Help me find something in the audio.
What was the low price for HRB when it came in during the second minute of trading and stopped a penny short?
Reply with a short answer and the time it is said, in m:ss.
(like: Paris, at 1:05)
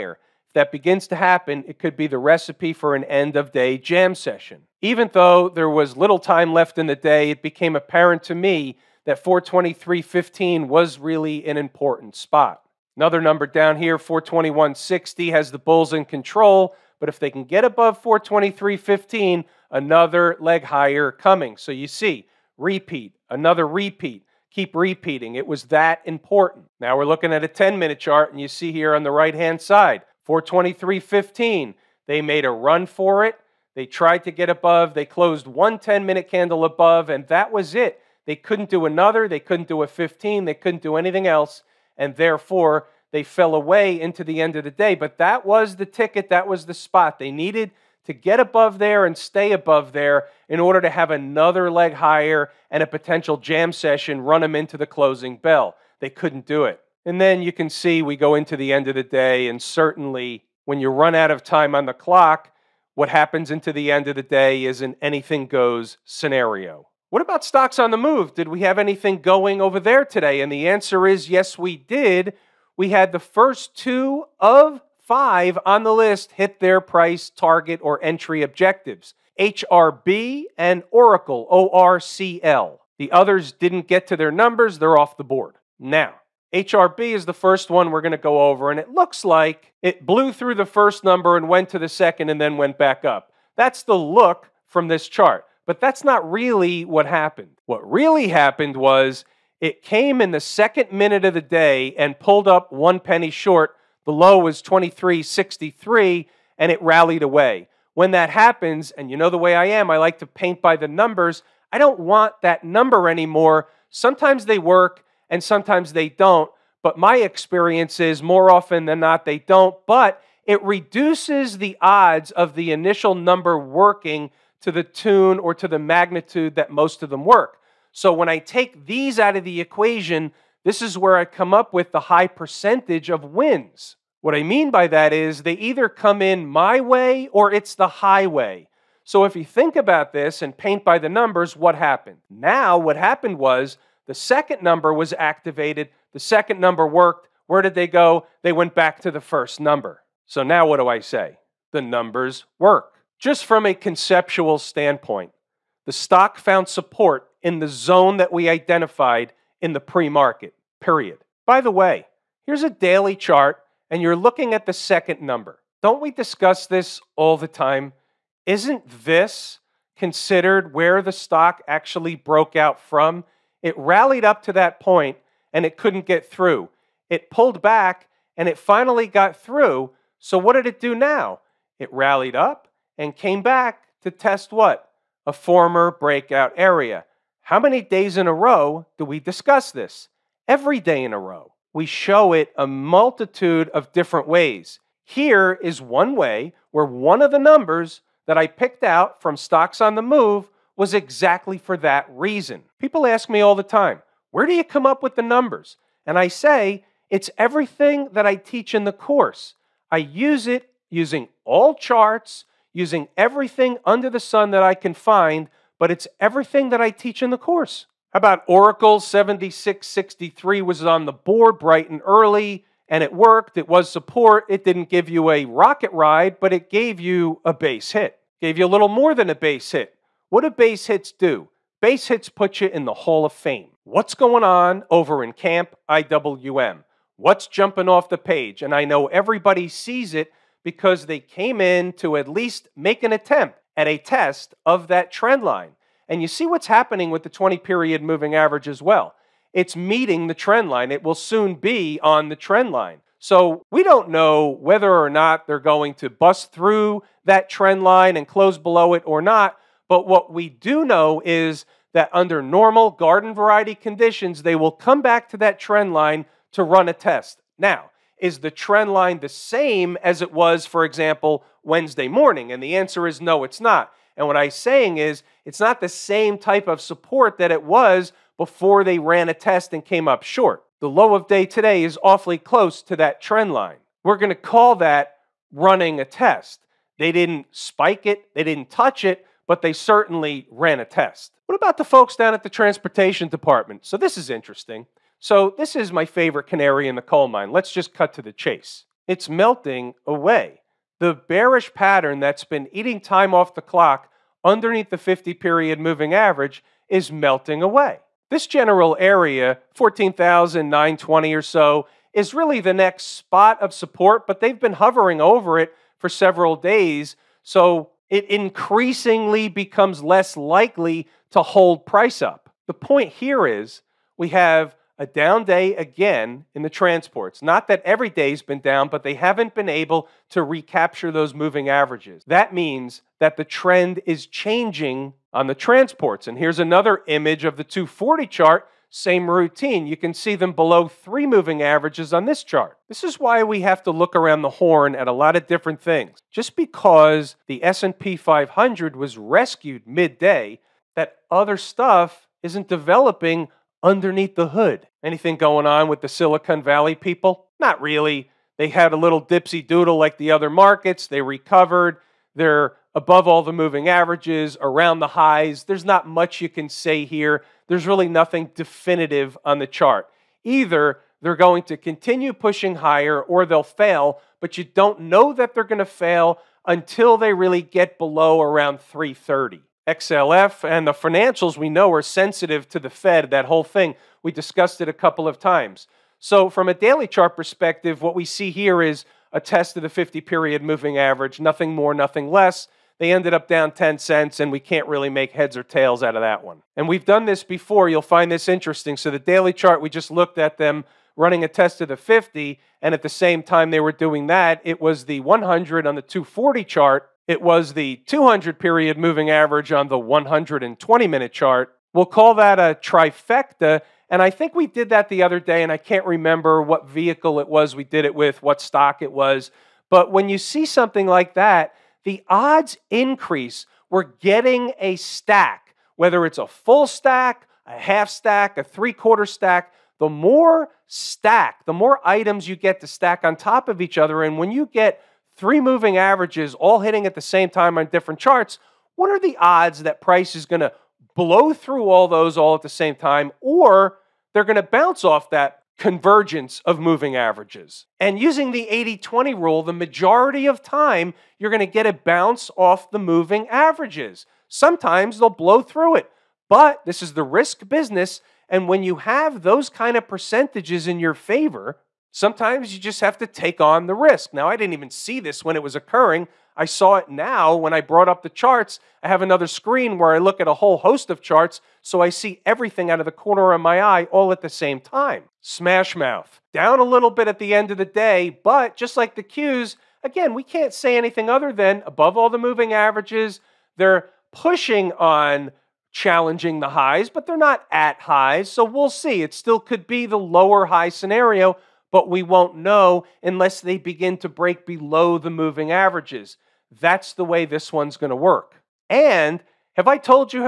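23.63, at 1:44.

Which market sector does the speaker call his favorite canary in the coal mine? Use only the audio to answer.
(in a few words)
Transportation.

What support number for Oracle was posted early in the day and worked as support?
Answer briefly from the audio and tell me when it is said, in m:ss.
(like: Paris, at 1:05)
76.63, at 3:39.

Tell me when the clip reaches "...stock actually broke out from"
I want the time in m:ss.
2:51.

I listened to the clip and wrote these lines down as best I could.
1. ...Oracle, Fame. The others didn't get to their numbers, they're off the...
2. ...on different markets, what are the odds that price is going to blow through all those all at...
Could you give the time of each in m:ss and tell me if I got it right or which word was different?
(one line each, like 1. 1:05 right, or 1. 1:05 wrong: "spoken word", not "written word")
1. 1:20 wrong: "ORCL", not "Fame"
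2. 7:17 wrong: "charts", not "markets".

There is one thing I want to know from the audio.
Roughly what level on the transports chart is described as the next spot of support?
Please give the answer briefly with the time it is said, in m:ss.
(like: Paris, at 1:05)
14,920, at 5:09.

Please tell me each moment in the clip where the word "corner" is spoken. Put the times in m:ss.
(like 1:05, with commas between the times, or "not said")
7:53.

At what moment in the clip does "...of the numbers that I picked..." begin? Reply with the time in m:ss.
3:17.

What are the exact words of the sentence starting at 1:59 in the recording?
But it reduces the odds of the initial number working to the tune or to the magnitude that most of them work.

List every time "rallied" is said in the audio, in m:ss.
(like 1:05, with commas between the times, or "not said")
1:46, 2:53, 3:01.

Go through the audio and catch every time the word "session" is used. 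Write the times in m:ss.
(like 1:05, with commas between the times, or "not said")
0:04, 0:53.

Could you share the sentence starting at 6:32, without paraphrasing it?
They ended up down 10 cents, and we can't really make heads or tails out of that one.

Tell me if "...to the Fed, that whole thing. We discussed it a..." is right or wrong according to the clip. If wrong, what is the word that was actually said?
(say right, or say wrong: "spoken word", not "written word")
right.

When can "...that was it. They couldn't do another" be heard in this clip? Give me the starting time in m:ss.
0:37.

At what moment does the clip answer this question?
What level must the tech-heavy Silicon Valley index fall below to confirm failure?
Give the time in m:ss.
6:18.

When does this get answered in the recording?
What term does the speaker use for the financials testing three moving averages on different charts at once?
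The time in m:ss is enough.
6:52.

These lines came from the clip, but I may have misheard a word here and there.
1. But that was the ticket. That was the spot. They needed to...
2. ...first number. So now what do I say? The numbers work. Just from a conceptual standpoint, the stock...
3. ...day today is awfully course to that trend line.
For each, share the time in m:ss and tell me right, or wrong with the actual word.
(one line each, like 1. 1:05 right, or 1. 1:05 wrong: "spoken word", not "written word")
1. 0:44 right
2. 2:29 right
3. 4:41 wrong: "close", not "course".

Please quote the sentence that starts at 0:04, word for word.
Even though there was little time left in the day, it became apparent to me that 423.15 was really an important spot.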